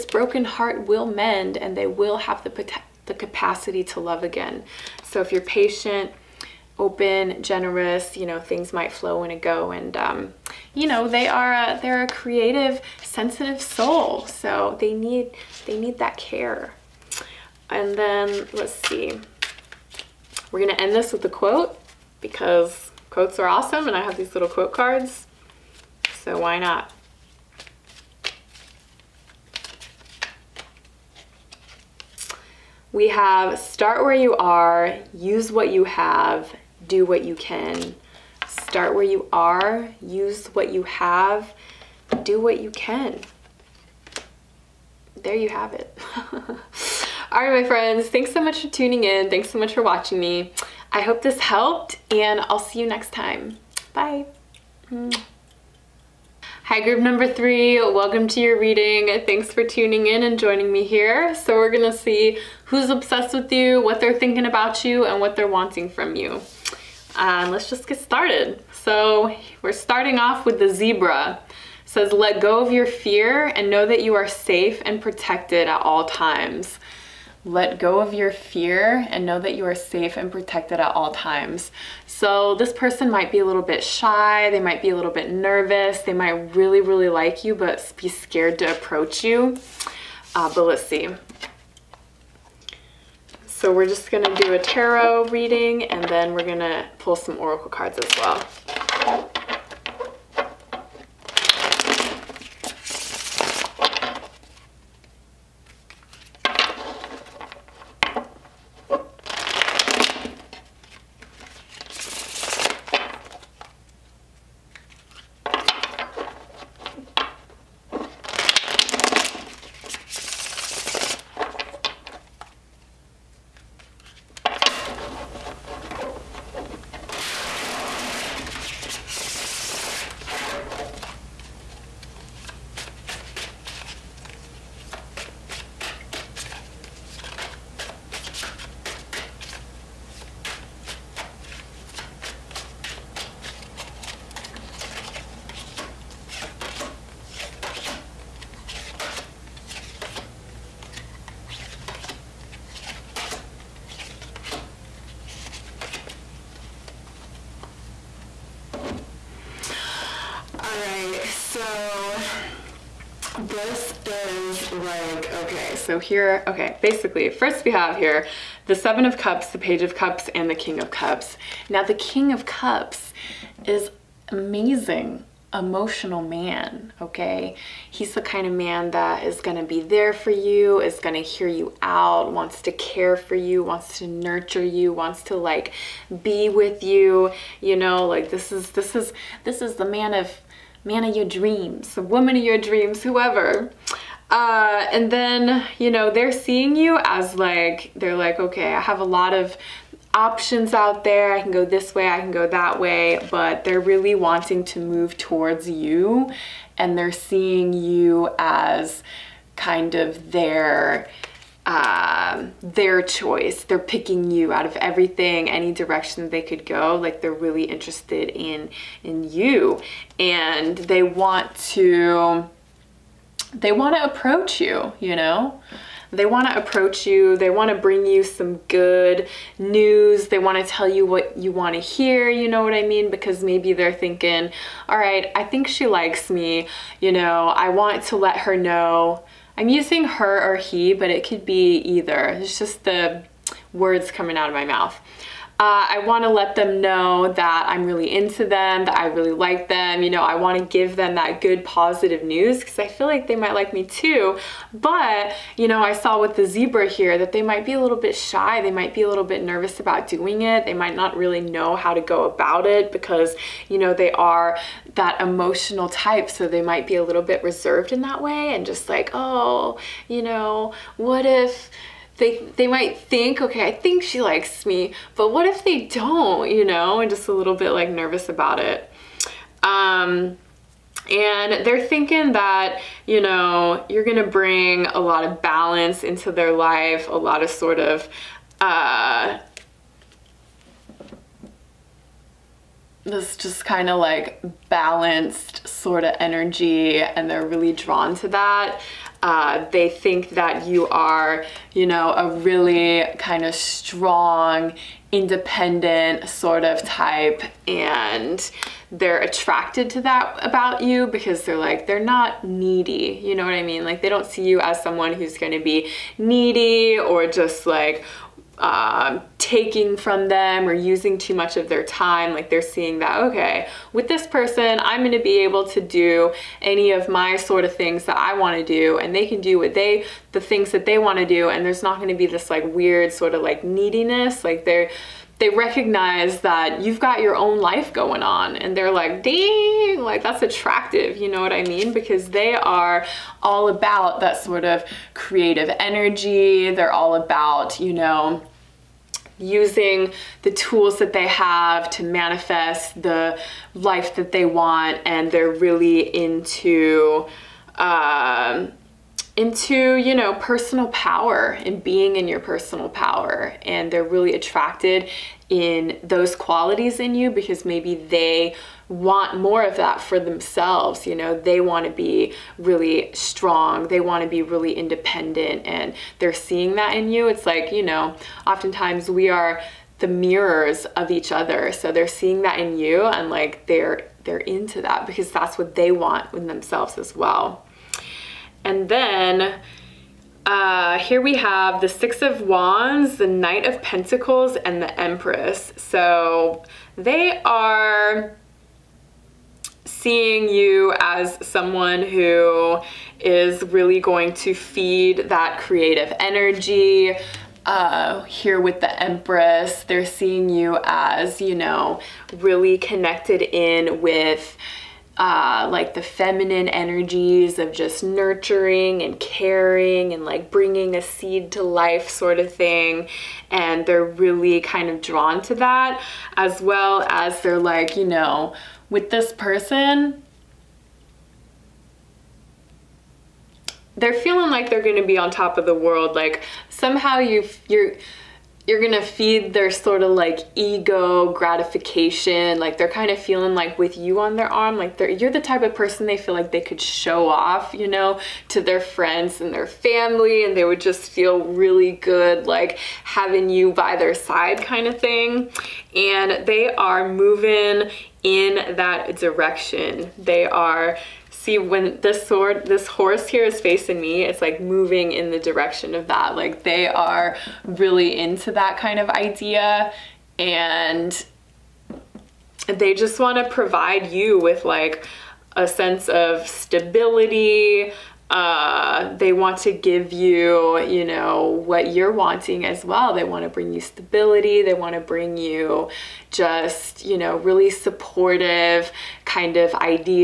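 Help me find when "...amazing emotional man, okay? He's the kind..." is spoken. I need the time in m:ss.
2:54.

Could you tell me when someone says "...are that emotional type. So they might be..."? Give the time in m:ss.
4:24.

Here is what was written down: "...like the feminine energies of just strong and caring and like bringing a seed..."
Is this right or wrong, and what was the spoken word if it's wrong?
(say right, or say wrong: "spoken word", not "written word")
wrong: "nurturing", not "strong".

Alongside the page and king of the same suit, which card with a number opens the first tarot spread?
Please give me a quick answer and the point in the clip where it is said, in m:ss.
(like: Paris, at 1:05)
Seven of Cups, at 2:48.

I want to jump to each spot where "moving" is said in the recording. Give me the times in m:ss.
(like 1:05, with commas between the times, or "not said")
7:37, 7:44.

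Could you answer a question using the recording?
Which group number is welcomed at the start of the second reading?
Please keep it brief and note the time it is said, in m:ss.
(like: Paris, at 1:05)
3, at 0:57.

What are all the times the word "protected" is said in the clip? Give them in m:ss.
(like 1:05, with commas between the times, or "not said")
1:15, 1:20.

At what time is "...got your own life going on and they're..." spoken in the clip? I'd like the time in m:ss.
5:36.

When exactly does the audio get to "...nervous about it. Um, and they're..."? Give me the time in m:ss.
4:37.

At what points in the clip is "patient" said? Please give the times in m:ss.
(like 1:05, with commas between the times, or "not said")
0:05.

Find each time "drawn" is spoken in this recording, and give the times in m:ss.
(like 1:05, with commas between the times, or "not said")
4:57, 7:05.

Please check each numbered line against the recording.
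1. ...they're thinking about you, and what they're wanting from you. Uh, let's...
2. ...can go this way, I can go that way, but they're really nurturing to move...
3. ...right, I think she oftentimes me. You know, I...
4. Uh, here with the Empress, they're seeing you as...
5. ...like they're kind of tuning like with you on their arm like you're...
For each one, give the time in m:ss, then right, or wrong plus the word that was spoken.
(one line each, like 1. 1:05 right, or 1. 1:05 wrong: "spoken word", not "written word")
1. 1:03 right
2. 3:21 wrong: "wanting", not "nurturing"
3. 3:54 wrong: "likes", not "oftentimes"
4. 6:47 right
5. 7:22 wrong: "feeling", not "tuning".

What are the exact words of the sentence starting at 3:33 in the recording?
They're picking you out of everything, any direction they could go.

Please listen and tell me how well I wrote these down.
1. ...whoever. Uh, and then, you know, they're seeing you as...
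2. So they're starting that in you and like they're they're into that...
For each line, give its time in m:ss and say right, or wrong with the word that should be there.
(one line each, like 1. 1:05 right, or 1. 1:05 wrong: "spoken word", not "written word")
1. 3:13 right
2. 6:21 wrong: "seeing", not "starting".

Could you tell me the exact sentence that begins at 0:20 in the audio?
We're gonna end this with a quote because quotes are awesome and I have these little quote cards, so why not?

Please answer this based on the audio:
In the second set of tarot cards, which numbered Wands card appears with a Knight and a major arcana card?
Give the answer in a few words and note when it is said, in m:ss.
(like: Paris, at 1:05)
Six of Wands, at 6:31.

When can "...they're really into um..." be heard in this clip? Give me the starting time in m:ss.
5:55.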